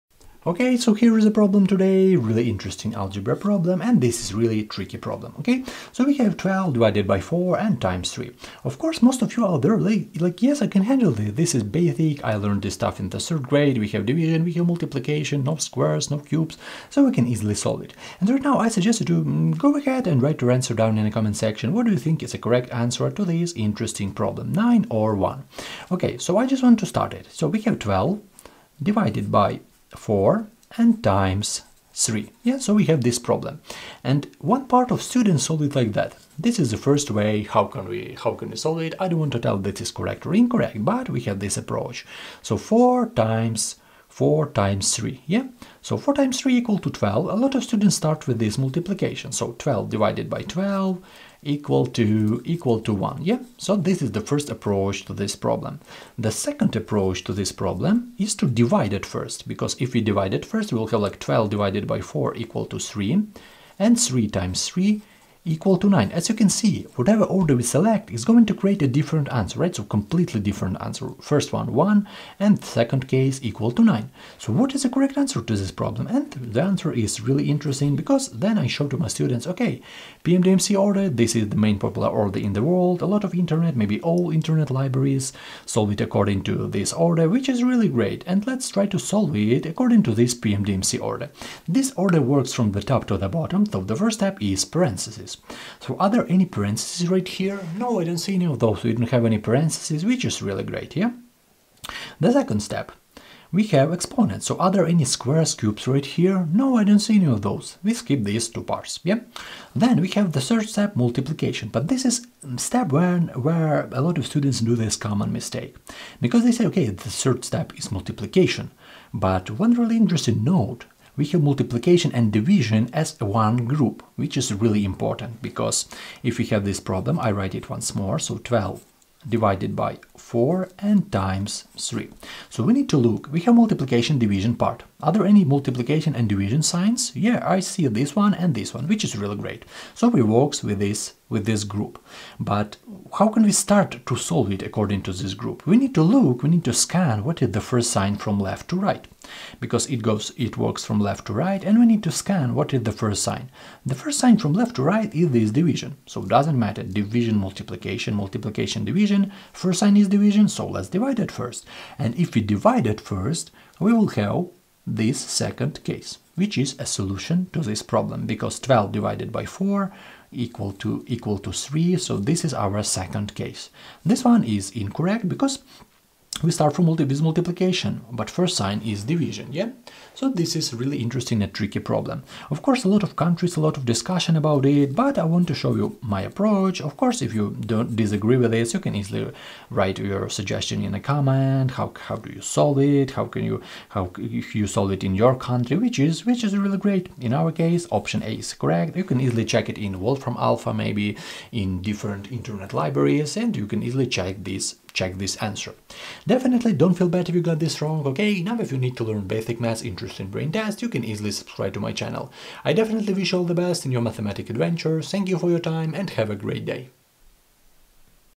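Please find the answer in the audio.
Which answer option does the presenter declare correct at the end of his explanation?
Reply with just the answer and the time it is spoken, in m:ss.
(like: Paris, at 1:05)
option A, at 3:17.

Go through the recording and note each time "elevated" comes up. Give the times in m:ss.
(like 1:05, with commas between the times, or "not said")
not said.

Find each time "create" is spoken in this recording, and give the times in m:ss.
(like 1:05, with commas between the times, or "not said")
1:08.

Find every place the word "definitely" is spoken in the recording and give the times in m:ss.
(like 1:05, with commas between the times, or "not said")
3:26, 3:32.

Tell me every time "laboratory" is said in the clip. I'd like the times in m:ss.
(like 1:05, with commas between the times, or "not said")
not said.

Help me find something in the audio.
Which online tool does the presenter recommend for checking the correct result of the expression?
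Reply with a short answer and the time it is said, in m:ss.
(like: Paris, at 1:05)
Wolfram Alpha, at 3:20.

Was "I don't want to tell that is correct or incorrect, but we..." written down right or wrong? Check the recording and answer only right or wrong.
right.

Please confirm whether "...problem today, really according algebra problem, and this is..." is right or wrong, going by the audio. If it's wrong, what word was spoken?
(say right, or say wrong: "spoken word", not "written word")
wrong: "interesting", not "according".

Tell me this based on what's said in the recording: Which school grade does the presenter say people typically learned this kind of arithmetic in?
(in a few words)
third grade.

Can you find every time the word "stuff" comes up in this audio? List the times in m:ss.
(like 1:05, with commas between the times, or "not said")
0:12.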